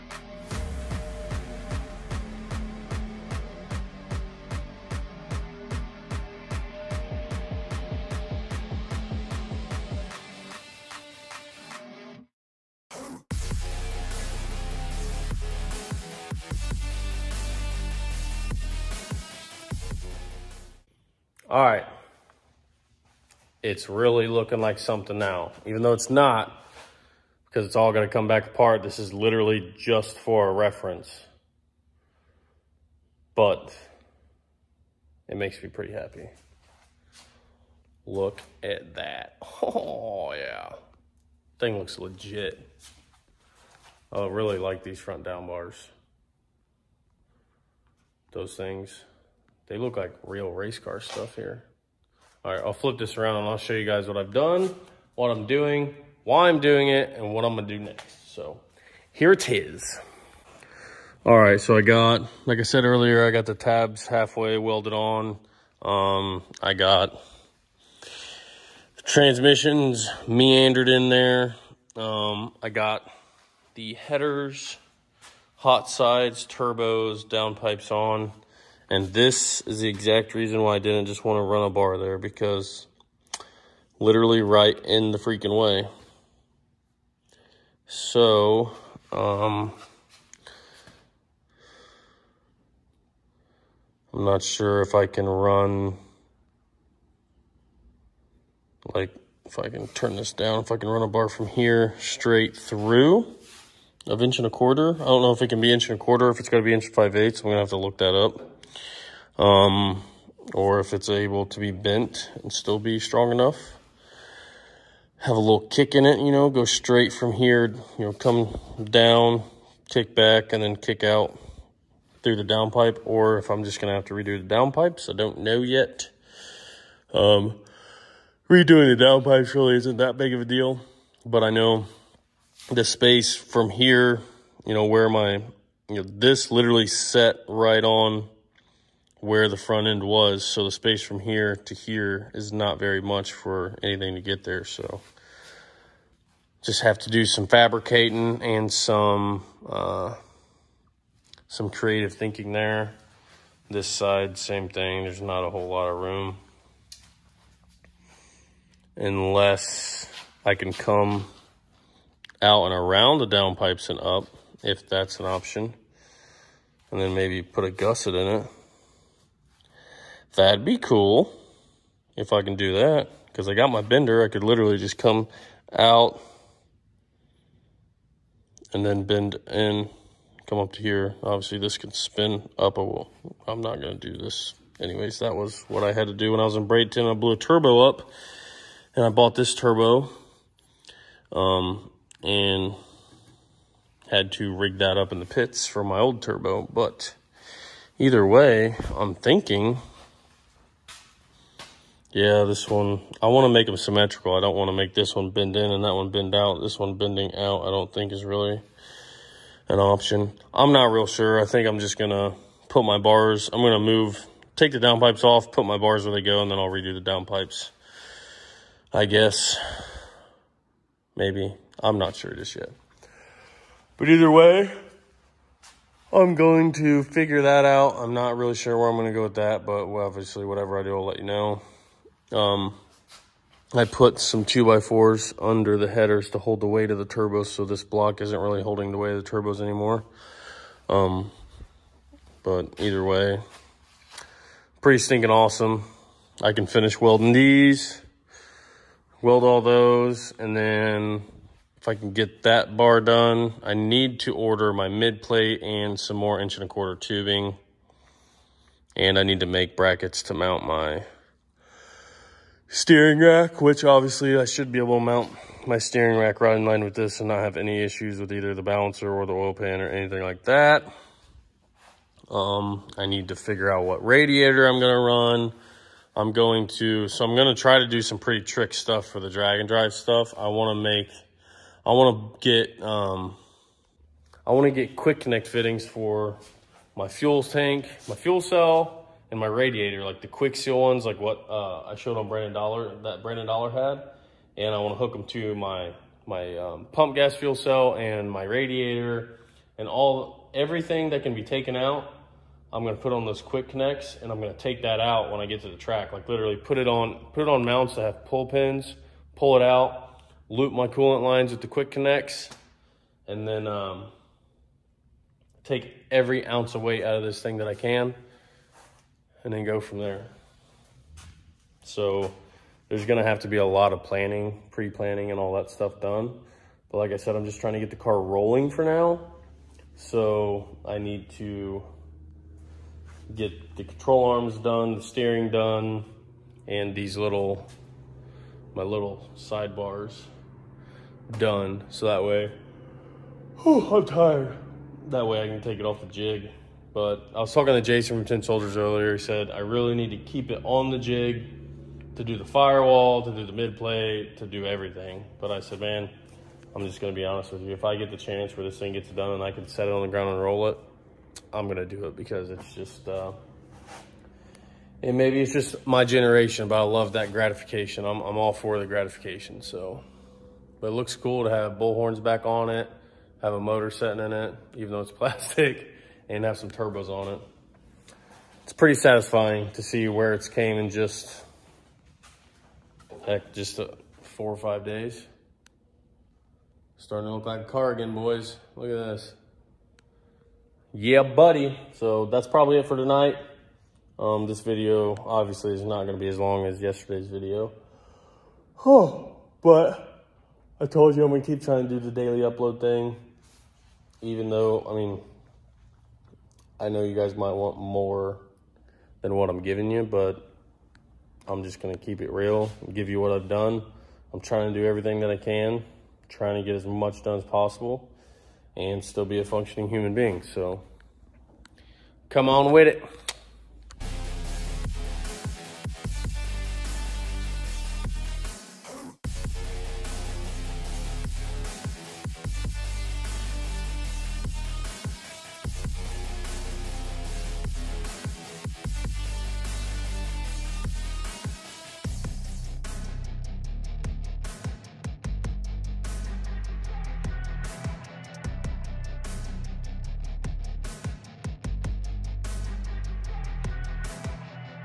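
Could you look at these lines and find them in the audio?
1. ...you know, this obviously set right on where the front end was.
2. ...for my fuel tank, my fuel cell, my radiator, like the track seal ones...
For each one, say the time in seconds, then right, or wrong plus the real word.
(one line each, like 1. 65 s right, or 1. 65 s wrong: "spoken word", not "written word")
1. 135 s wrong: "literally", not "obviously"
2. 285 s wrong: "quick", not "track".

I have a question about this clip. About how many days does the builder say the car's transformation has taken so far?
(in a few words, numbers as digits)
4 or 5 days.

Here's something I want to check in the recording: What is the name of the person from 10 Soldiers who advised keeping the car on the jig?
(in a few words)
Jason.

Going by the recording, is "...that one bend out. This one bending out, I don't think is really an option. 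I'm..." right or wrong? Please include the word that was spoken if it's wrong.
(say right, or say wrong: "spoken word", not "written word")
right.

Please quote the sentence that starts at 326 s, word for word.
But like I said, I'm just trying to get the car rolling for now.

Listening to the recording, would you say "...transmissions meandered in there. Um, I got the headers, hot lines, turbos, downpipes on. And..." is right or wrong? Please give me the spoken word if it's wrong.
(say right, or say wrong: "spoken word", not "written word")
wrong: "sides", not "lines".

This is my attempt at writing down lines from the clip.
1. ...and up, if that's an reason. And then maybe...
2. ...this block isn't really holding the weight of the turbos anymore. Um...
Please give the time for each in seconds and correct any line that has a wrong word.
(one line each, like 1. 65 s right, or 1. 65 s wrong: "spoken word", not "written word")
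1. 163 s wrong: "option", not "reason"
2. 237 s right.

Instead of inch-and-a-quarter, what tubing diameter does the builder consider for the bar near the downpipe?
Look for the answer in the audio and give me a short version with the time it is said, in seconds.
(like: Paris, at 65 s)
1 5/8 inch, at 106 s.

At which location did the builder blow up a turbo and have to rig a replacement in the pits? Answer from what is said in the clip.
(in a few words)
Bradenton.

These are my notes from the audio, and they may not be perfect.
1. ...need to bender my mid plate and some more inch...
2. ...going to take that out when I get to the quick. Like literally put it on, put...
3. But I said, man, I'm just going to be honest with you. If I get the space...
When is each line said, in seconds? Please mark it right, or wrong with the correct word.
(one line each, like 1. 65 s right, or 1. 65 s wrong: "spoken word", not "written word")
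1. 253 s wrong: "order", not "bender"
2. 304 s wrong: "track", not "quick"
3. 355 s wrong: "chance", not "space".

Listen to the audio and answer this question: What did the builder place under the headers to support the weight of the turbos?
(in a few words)
2x4s.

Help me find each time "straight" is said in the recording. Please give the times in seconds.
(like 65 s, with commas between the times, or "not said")
101 s, 116 s.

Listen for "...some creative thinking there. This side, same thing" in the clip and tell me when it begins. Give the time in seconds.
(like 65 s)
151 s.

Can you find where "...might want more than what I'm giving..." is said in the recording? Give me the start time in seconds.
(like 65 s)
407 s.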